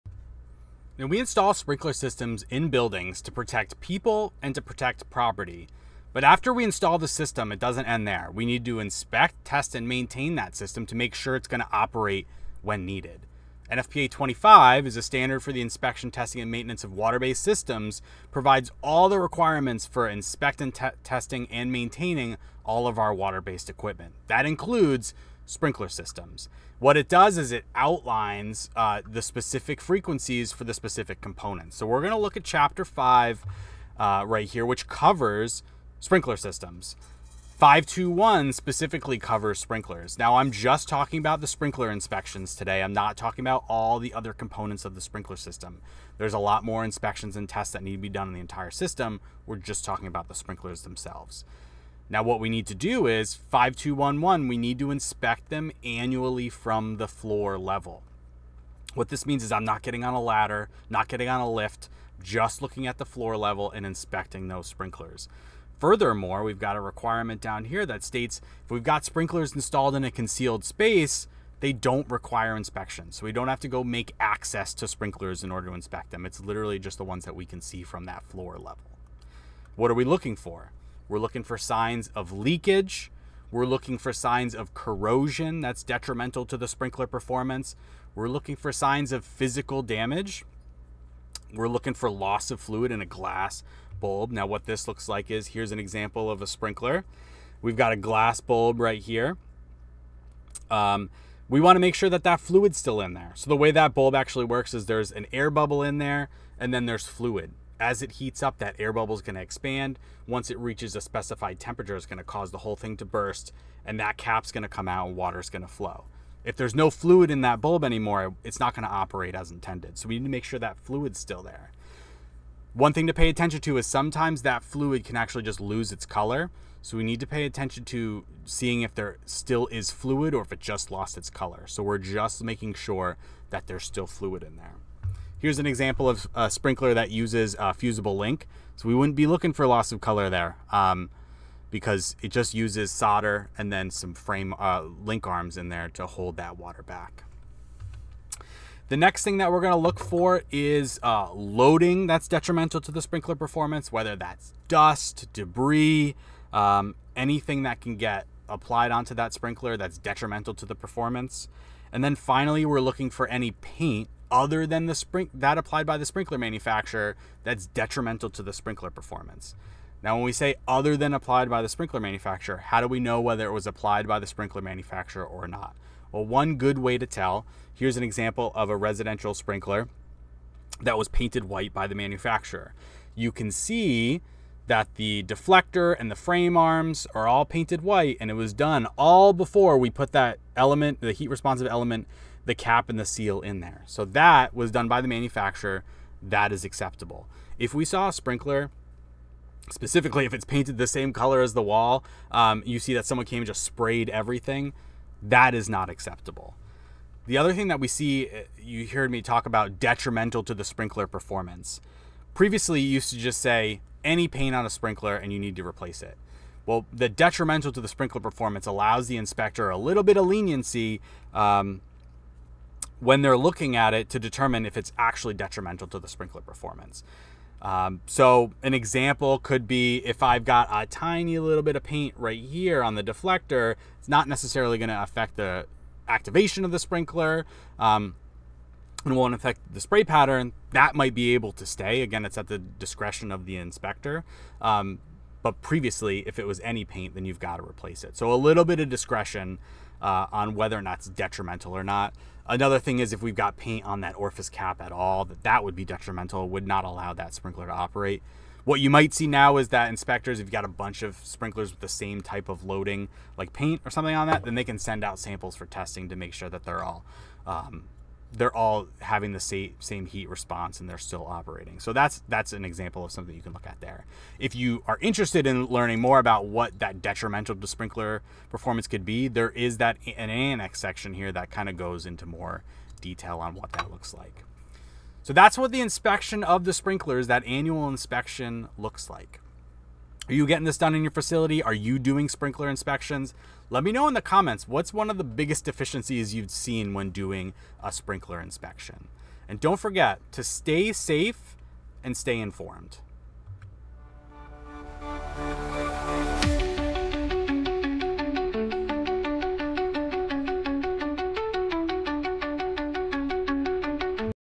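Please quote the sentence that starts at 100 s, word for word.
Um, we want to make sure that that fluid's still in there.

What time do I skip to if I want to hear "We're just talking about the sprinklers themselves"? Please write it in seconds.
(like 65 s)
49 s.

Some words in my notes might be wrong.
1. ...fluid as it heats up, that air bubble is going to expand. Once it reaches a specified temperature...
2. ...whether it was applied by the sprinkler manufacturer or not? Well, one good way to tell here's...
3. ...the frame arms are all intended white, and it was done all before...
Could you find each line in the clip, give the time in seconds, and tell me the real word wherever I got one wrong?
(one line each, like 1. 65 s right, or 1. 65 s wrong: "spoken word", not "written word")
1. 107 s right
2. 173 s right
3. 186 s wrong: "painted", not "intended".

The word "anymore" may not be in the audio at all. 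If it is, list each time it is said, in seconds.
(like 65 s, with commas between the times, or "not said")
117 s.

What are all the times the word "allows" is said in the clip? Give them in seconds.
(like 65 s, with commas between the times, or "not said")
218 s, 256 s.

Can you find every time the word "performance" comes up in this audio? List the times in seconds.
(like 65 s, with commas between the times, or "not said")
87 s, 153 s, 160 s, 168 s, 211 s, 218 s, 226 s, 278 s.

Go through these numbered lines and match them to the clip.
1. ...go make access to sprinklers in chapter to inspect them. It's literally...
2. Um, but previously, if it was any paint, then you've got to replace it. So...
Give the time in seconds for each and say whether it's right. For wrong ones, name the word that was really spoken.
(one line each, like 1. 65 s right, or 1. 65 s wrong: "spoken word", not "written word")
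1. 73 s wrong: "order", not "chapter"
2. 244 s right.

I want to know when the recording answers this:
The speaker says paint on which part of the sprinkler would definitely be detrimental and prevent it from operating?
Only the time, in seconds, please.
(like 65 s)
254 s.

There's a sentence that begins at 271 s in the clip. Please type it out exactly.
So that's that's an example of something you can look at there.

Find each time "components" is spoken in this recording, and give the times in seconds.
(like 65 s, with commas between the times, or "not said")
31 s, 44 s.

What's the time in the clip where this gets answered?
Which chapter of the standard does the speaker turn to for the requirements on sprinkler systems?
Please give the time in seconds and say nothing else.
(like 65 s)
32 s.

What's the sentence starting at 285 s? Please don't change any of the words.
So that's what the inspection of the sprinklers, that annual inspection looks like.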